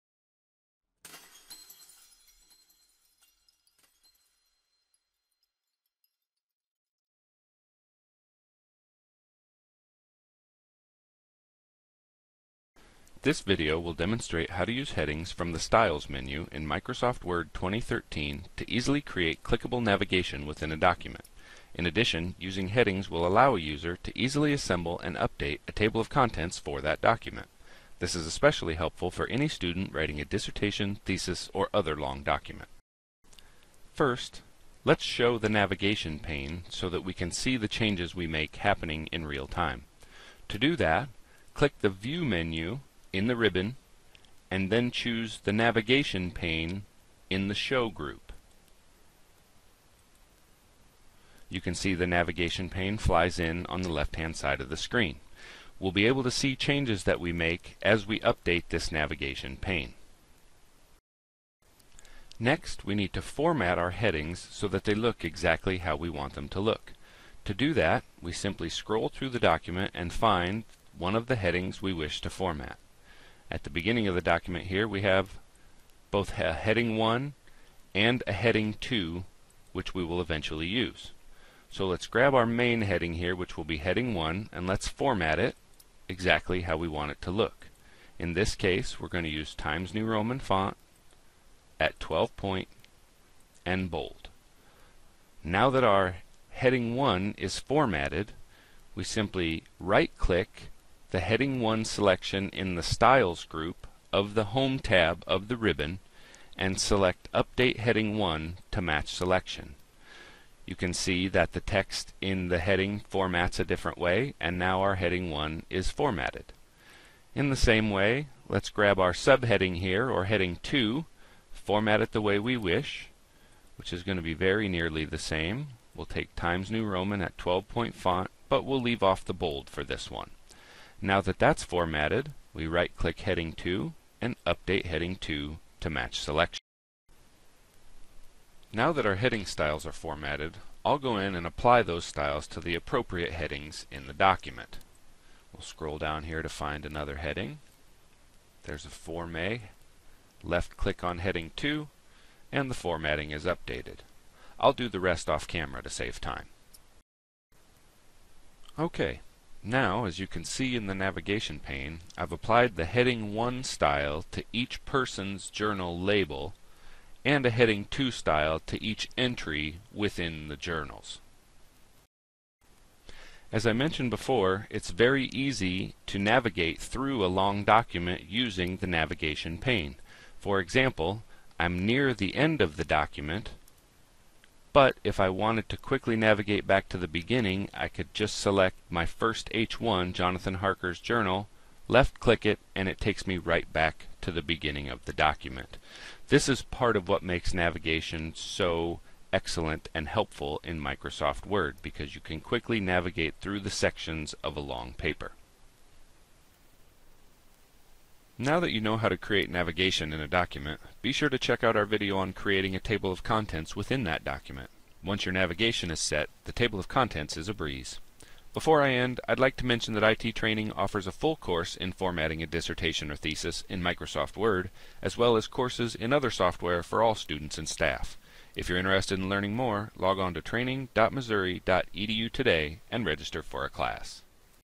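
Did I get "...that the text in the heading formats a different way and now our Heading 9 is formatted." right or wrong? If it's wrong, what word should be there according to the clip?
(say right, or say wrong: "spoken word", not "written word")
wrong: "1", not "9".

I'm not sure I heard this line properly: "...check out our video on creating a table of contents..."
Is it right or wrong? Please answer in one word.
right.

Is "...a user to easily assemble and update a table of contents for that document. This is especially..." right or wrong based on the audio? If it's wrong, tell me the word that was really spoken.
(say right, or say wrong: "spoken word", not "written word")
right.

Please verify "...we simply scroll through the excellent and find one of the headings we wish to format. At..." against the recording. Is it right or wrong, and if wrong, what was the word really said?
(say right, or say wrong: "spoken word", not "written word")
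wrong: "document", not "excellent".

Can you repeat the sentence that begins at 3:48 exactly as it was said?
If you're interested in learning more, log on to training.missouri.edu today and register for a class.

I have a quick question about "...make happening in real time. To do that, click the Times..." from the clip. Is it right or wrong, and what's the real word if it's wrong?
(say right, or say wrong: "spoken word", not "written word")
wrong: "View", not "Times".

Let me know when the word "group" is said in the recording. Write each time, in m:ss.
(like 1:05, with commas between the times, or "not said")
0:47, 1:43.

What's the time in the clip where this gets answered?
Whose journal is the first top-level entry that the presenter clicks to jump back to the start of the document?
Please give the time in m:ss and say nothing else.
3:10.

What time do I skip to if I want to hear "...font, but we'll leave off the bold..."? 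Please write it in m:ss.
2:07.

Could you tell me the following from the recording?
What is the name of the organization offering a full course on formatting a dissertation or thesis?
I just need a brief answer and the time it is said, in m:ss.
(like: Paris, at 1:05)
IT Training, at 3:40.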